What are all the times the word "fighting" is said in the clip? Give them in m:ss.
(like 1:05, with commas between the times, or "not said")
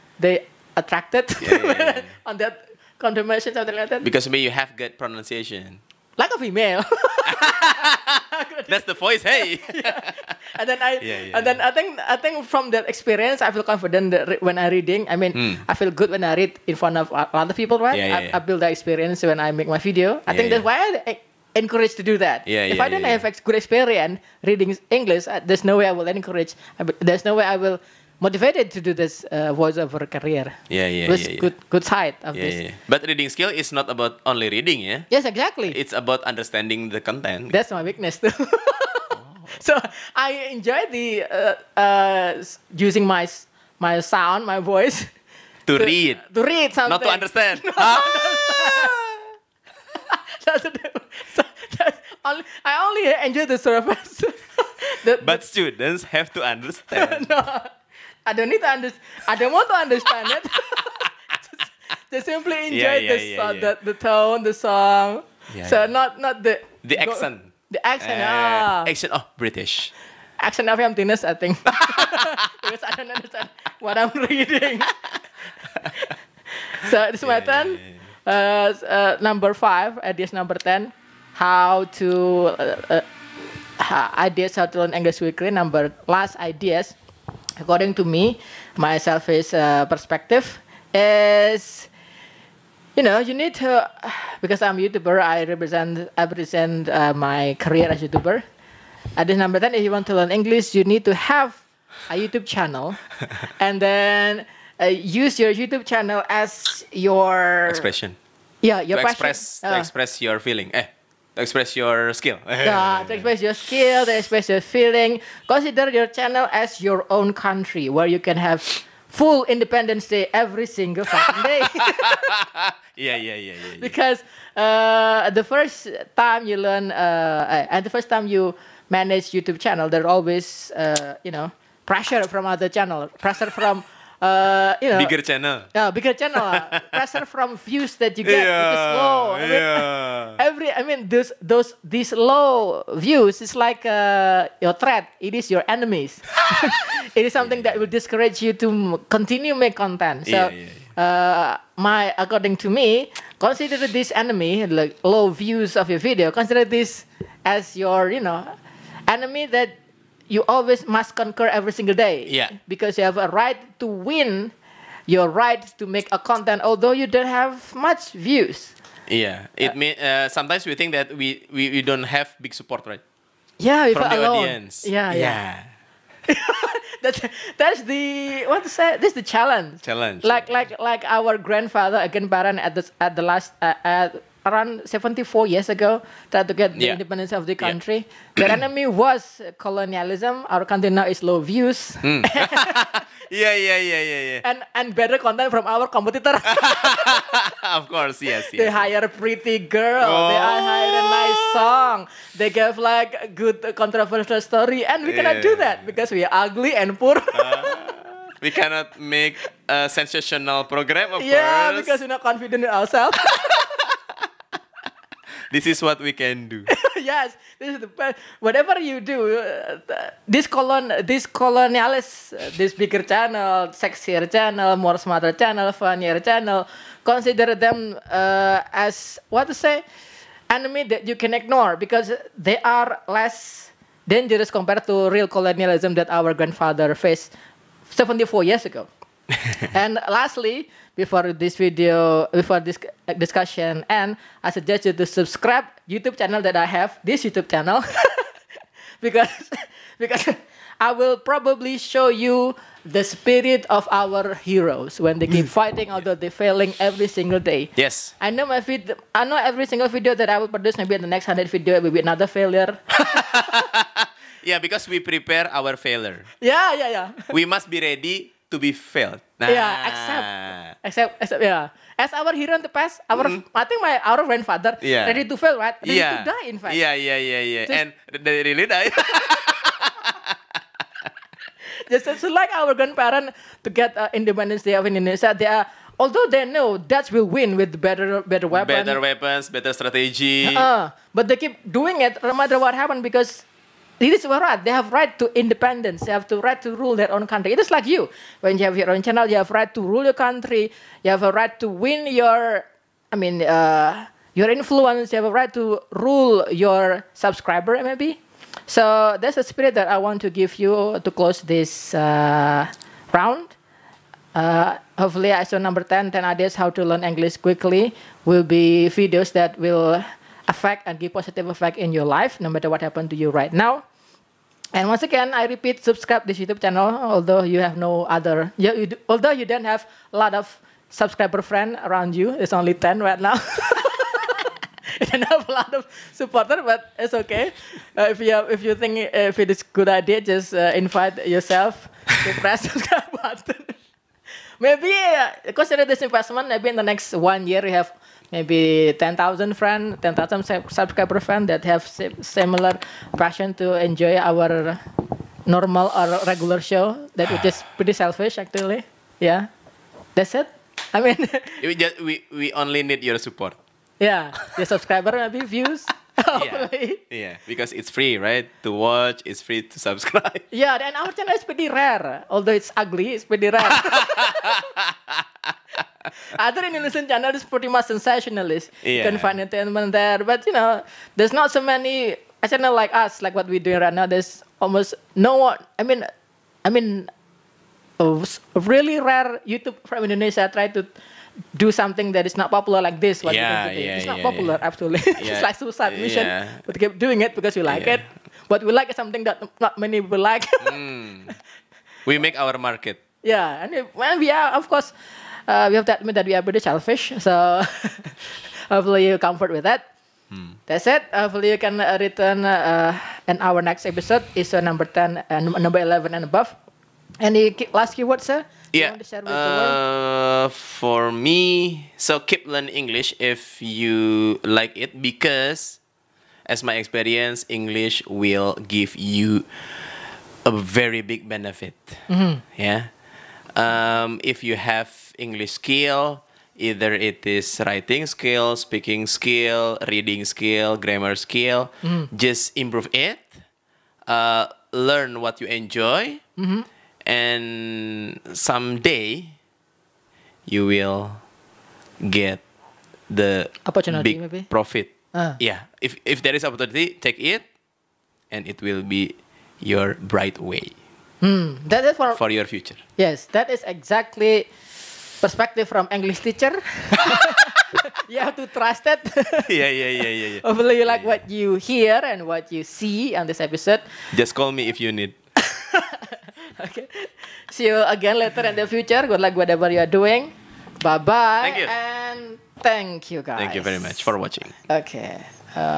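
4:15.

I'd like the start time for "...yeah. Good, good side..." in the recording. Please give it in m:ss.
0:31.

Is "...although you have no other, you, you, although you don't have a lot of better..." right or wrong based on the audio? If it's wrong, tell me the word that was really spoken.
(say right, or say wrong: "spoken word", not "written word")
wrong: "subscriber", not "better".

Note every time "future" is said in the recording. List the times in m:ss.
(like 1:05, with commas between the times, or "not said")
7:42, 7:58.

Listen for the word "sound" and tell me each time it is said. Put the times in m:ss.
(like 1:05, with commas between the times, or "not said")
0:44.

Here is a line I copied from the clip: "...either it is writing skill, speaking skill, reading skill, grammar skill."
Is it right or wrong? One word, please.
right.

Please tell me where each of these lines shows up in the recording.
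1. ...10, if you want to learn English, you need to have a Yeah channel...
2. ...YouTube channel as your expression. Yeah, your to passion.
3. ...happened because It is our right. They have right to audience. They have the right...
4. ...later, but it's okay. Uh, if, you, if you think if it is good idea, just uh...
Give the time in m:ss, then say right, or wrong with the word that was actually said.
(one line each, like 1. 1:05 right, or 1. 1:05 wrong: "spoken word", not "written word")
1. 1:39 wrong: "YouTube", not "Yeah"
2. 1:45 right
3. 4:52 wrong: "independence", not "audience"
4. 5:36 wrong: "supporter", not "later".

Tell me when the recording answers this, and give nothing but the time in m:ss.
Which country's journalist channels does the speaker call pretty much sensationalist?
6:16.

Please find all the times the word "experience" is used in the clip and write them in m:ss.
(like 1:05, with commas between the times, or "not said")
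0:12, 0:18, 0:23, 7:06.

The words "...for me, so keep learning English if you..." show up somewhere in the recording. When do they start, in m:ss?
7:00.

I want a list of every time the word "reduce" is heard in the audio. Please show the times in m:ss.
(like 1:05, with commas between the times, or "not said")
not said.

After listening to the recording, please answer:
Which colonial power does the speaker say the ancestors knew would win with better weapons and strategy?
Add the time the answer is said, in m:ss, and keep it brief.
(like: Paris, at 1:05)
Dutch, at 4:46.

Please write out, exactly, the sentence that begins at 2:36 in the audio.
Consider this as your you know enemy that you always must conquer every single day.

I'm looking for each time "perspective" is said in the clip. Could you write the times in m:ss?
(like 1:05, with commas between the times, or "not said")
1:29, 7:45.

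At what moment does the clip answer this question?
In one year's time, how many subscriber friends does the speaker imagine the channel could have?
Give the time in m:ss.
5:50.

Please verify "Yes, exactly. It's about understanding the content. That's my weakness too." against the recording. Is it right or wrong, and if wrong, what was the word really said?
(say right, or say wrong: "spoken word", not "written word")
right.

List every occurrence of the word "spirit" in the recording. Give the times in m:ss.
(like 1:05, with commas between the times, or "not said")
4:13, 5:09.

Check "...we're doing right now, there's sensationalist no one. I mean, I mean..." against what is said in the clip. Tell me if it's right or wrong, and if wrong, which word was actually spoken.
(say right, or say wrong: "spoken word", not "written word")
wrong: "almost", not "sensationalist".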